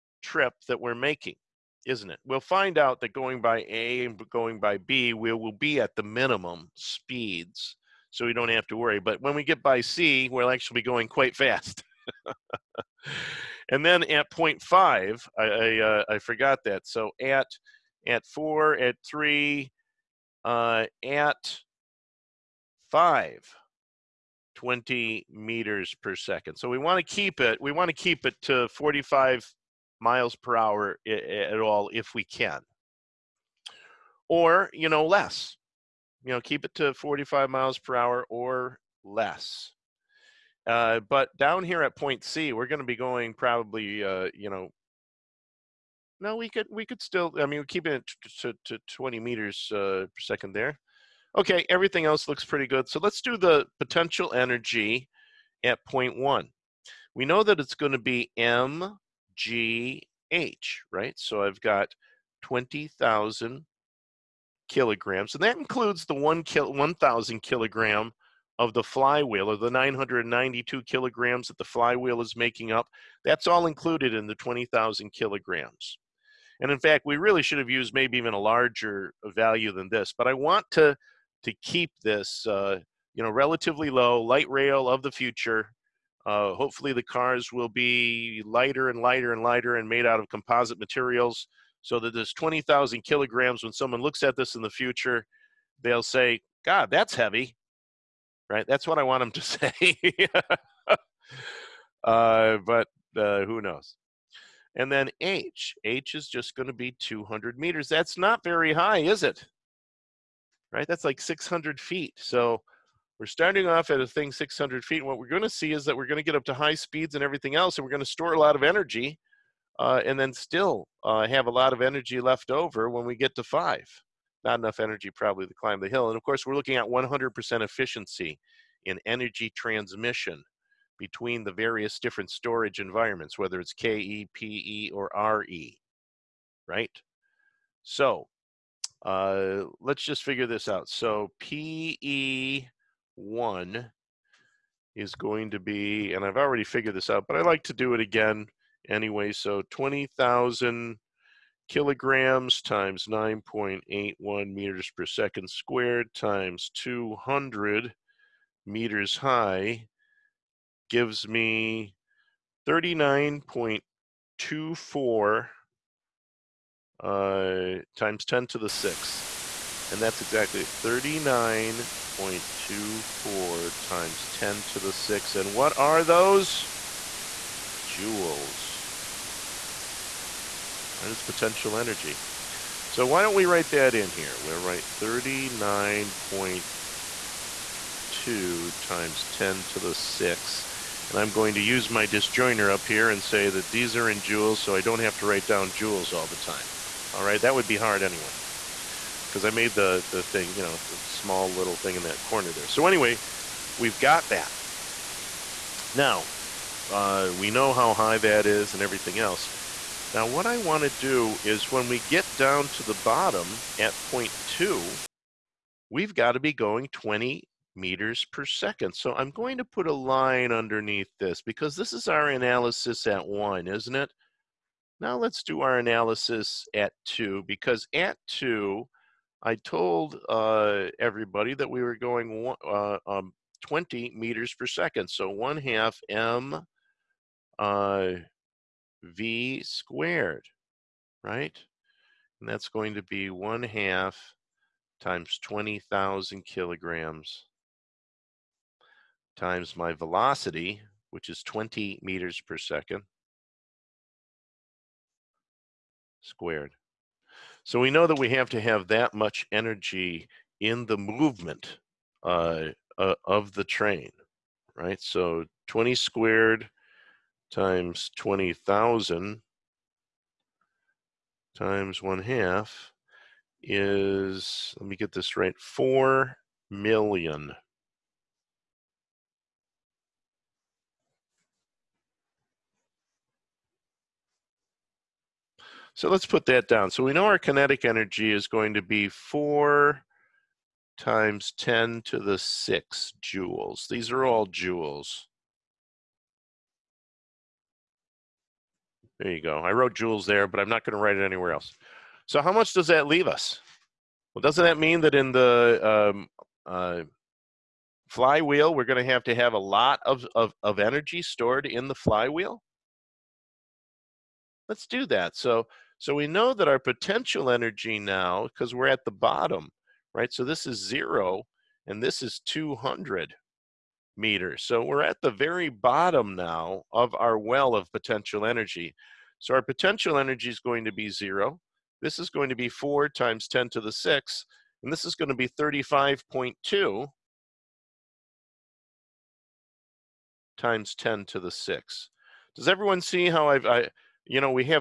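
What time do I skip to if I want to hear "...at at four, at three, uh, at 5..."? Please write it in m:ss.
0:17.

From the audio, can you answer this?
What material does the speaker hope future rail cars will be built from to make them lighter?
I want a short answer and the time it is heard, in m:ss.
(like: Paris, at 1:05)
composite materials, at 1:30.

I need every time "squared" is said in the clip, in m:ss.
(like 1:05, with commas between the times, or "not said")
2:35, 3:59, 4:16, 4:25.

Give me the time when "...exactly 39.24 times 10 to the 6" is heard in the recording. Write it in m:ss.
2:50.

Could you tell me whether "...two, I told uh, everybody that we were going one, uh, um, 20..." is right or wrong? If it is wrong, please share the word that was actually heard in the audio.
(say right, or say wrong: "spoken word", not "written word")
right.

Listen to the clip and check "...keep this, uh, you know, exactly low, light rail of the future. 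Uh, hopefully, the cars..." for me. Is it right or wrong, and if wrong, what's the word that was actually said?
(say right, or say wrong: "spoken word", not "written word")
wrong: "relatively", not "exactly".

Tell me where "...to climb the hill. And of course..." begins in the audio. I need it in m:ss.
2:05.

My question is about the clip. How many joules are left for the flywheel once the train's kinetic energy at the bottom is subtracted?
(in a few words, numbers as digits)
35.2 x 10^6.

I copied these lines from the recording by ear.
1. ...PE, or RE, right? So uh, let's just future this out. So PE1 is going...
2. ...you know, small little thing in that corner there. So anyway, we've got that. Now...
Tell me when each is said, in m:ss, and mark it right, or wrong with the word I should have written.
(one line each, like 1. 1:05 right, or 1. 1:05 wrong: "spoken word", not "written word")
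1. 2:14 wrong: "figure", not "future"
2. 3:20 right.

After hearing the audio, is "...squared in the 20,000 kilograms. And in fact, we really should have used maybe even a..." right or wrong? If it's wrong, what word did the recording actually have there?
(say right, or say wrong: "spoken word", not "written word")
wrong: "included", not "squared".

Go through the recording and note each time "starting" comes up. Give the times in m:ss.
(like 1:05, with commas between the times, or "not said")
1:53.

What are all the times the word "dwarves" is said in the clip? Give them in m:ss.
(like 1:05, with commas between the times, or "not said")
not said.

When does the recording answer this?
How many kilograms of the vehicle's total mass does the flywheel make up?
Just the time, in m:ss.
1:09.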